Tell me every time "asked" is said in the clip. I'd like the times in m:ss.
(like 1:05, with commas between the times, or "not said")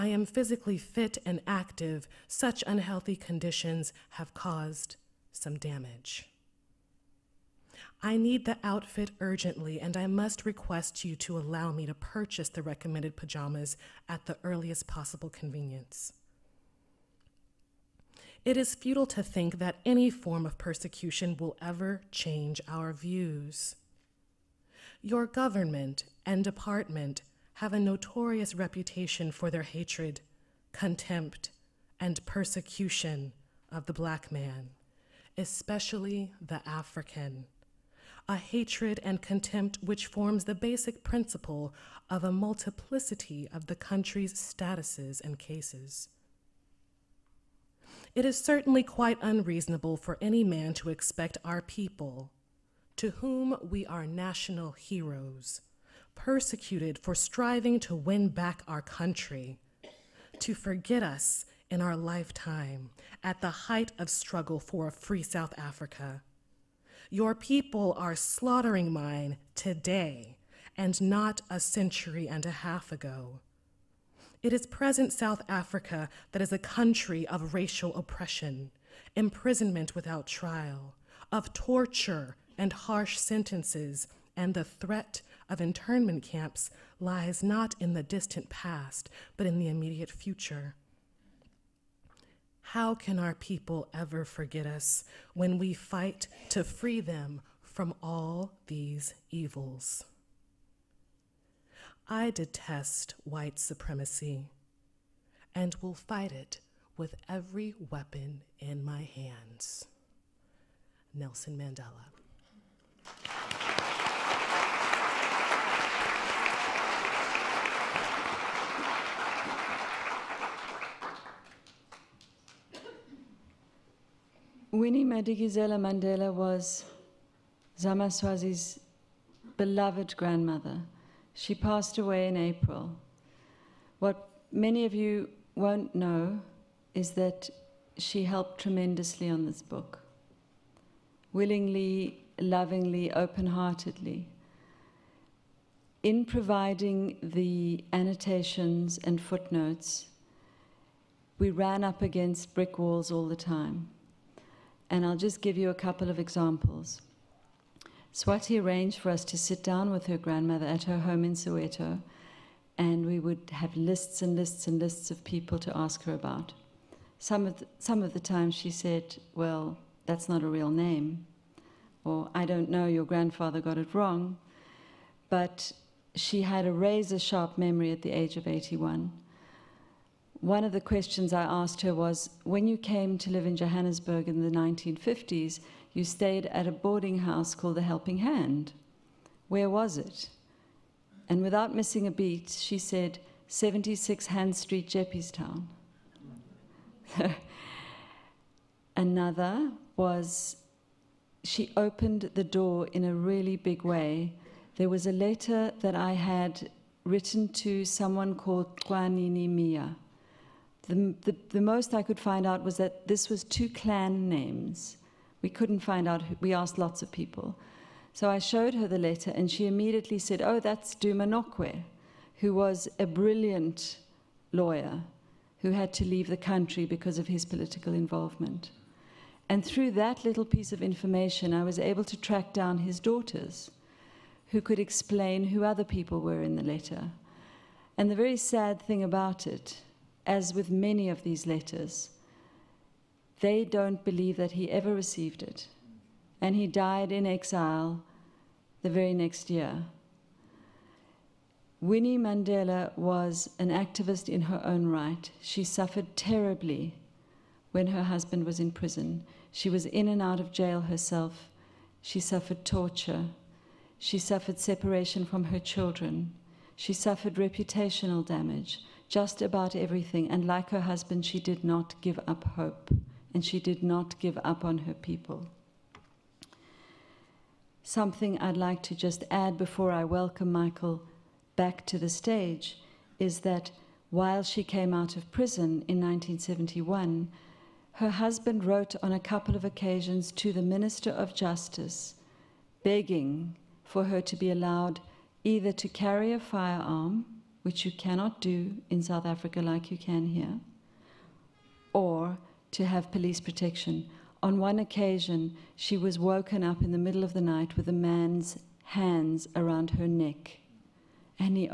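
3:01, 3:36.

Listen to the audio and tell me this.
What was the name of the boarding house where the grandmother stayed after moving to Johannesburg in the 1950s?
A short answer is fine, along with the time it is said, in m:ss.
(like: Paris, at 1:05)
Helping Hand, at 3:07.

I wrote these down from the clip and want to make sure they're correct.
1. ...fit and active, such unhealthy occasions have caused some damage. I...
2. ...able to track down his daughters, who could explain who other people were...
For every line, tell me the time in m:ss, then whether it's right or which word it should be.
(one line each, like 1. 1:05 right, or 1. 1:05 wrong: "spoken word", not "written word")
1. 0:00 wrong: "conditions", not "occasions"
2. 3:51 right.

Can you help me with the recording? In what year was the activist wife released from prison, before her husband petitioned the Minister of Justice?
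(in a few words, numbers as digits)
1971.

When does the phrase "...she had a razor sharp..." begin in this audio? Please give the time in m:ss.
2:56.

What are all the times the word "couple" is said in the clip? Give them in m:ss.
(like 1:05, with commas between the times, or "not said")
2:35, 4:49.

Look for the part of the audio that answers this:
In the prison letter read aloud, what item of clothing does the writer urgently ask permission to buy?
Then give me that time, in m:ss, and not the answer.
0:13.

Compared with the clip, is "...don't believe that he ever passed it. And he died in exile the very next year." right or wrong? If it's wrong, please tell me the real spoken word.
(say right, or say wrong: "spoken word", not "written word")
wrong: "received", not "passed".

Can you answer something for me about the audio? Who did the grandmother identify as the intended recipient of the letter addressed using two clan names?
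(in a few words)
Duma.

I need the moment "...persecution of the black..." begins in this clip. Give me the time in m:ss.
0:32.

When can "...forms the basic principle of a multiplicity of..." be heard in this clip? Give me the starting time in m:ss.
0:40.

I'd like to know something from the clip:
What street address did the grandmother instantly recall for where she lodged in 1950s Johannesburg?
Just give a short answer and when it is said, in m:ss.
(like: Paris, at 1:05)
76 Hand Street, Jeppestown, at 3:13.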